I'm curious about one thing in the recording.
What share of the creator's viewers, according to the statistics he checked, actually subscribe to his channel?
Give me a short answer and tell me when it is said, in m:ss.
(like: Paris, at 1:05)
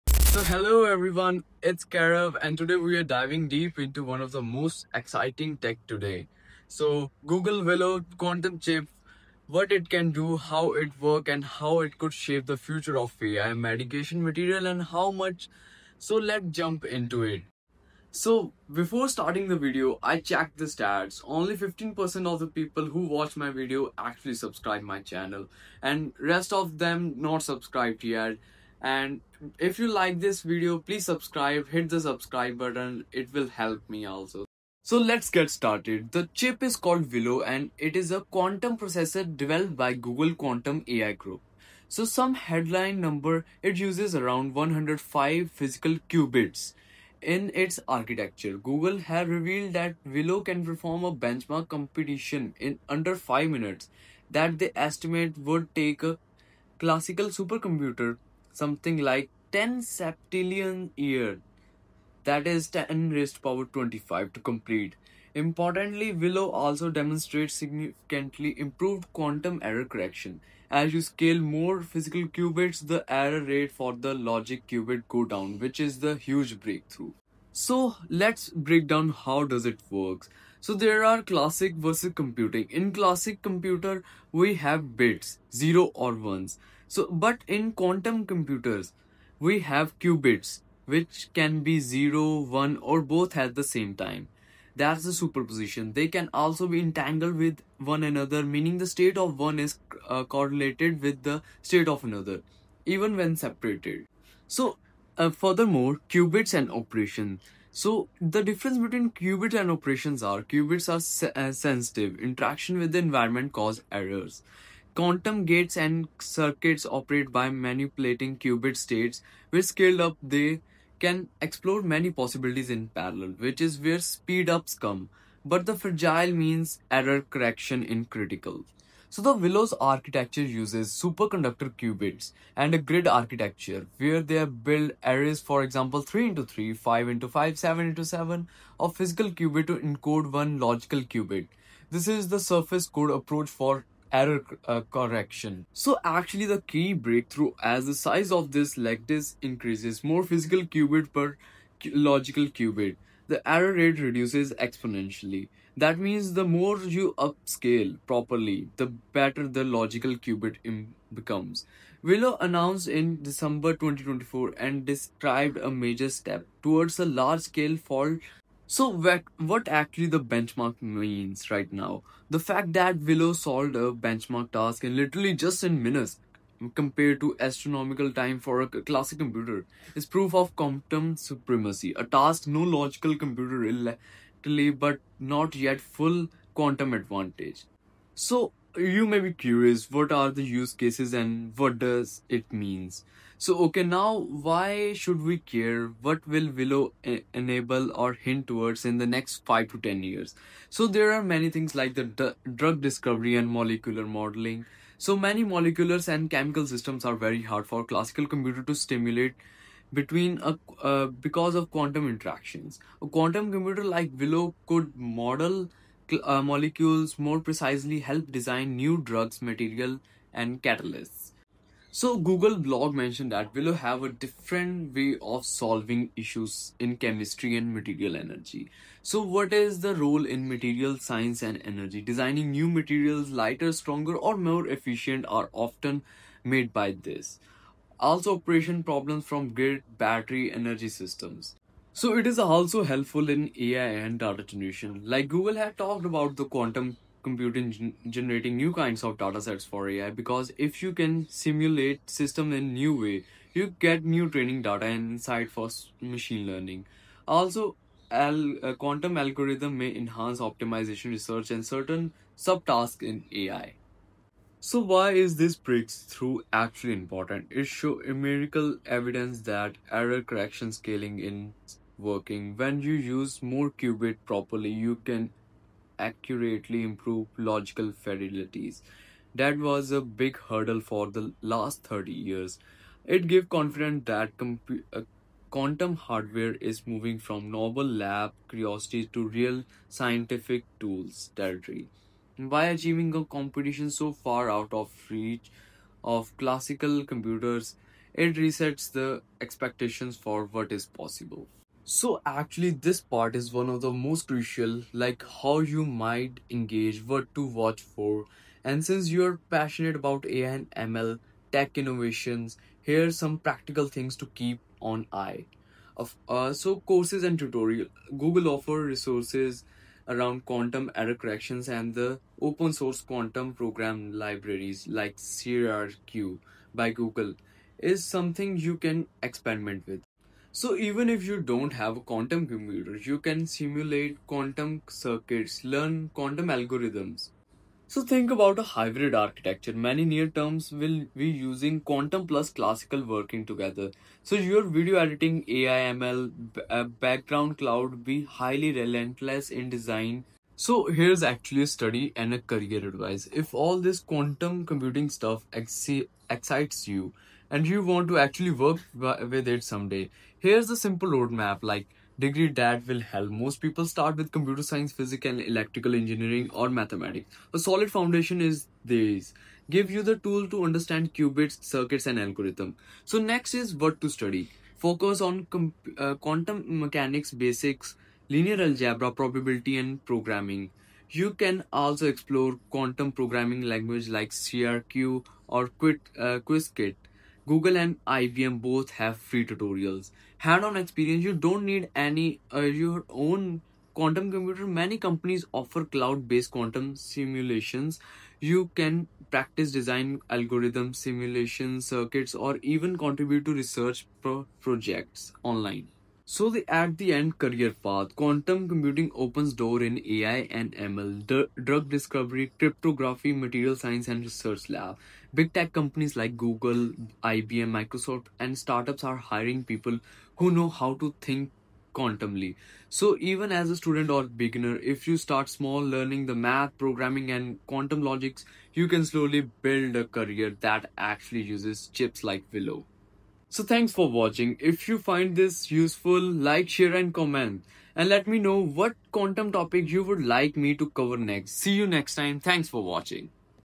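15%, at 0:21.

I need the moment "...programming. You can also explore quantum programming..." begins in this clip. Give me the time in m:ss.
6:20.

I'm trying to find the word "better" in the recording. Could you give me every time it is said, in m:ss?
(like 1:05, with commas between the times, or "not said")
2:38.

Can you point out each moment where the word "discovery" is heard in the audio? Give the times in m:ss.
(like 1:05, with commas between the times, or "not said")
3:22, 6:51.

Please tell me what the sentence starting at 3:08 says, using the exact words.
So you may be curious, what are the use cases and what does it means?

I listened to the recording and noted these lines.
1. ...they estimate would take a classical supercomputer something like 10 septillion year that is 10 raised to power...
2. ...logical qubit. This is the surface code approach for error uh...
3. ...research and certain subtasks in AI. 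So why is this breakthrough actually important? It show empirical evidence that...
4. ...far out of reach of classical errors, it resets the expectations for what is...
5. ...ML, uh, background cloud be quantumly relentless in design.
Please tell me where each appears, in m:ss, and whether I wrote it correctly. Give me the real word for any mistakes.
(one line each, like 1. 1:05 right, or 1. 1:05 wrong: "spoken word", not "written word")
1. 0:54 right
2. 2:20 right
3. 4:21 right
4. 4:54 wrong: "computers", not "errors"
5. 5:45 wrong: "highly", not "quantumly".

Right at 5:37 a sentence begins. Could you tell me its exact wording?
So think about a hybrid architecture.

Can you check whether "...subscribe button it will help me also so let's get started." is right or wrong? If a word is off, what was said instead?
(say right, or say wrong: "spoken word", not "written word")
right.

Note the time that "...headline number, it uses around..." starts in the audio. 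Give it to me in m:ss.
0:42.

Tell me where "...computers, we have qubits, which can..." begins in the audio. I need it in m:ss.
1:28.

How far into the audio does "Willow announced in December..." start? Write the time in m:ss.
2:42.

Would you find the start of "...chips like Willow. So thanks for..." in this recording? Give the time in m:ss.
7:11.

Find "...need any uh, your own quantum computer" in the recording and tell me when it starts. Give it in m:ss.
6:31.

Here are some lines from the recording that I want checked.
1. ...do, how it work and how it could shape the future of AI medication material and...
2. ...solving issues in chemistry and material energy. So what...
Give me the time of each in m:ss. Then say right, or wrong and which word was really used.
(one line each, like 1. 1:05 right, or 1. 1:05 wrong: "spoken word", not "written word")
1. 0:10 right
2. 3:45 right.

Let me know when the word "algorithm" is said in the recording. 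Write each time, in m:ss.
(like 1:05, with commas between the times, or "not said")
4:19, 5:36, 6:12, 6:40.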